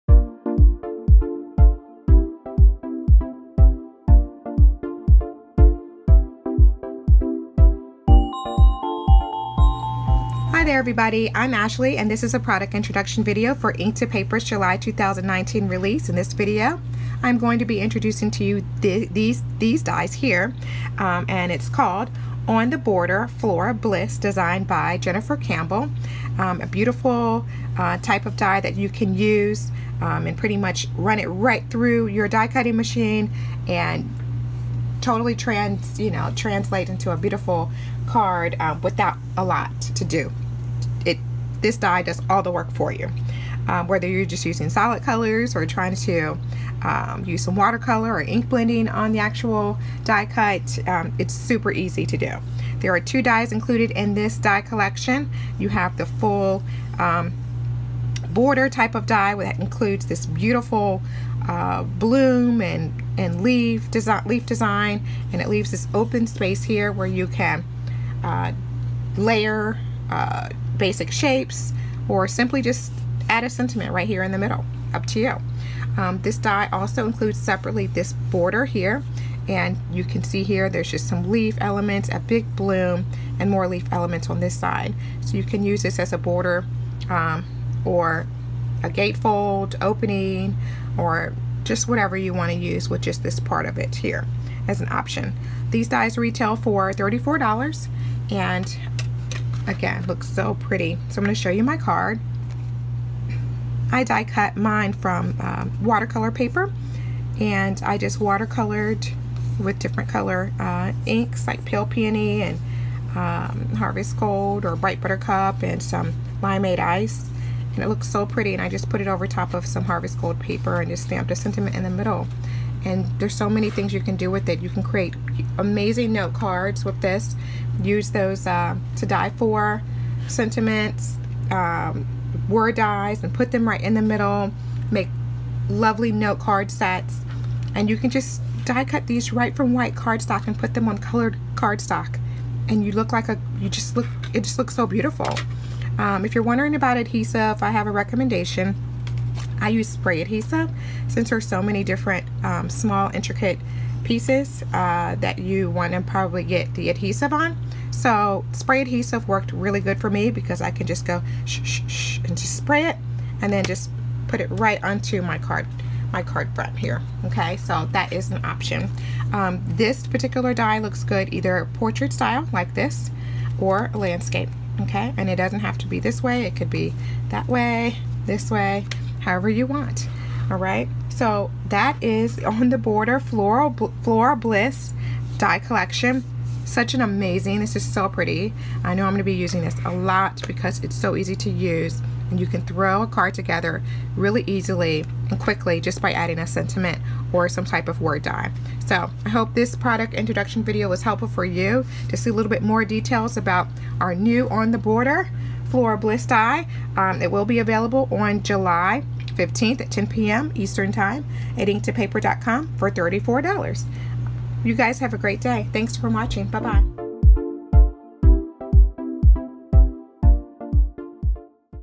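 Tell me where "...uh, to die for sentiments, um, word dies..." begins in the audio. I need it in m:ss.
2:08.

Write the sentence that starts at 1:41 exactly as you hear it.
So I'm going to show you my card.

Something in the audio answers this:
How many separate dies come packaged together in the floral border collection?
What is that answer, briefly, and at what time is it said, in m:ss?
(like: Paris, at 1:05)
2, at 0:52.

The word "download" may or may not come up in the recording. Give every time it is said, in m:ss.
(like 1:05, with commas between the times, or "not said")
not said.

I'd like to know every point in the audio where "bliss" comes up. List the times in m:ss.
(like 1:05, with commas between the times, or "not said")
0:23, 3:04, 3:25.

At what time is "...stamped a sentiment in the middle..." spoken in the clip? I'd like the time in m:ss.
2:01.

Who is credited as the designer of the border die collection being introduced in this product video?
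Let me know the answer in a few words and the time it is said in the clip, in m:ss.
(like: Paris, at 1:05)
Jennifer Campbell, at 0:24.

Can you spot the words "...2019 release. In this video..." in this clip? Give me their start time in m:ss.
0:14.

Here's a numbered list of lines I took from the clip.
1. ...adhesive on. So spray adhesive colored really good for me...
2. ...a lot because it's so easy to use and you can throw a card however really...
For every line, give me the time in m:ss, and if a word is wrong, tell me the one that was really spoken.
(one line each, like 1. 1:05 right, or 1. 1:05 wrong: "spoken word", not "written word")
1. 2:36 wrong: "worked", not "colored"
2. 3:09 wrong: "together", not "however".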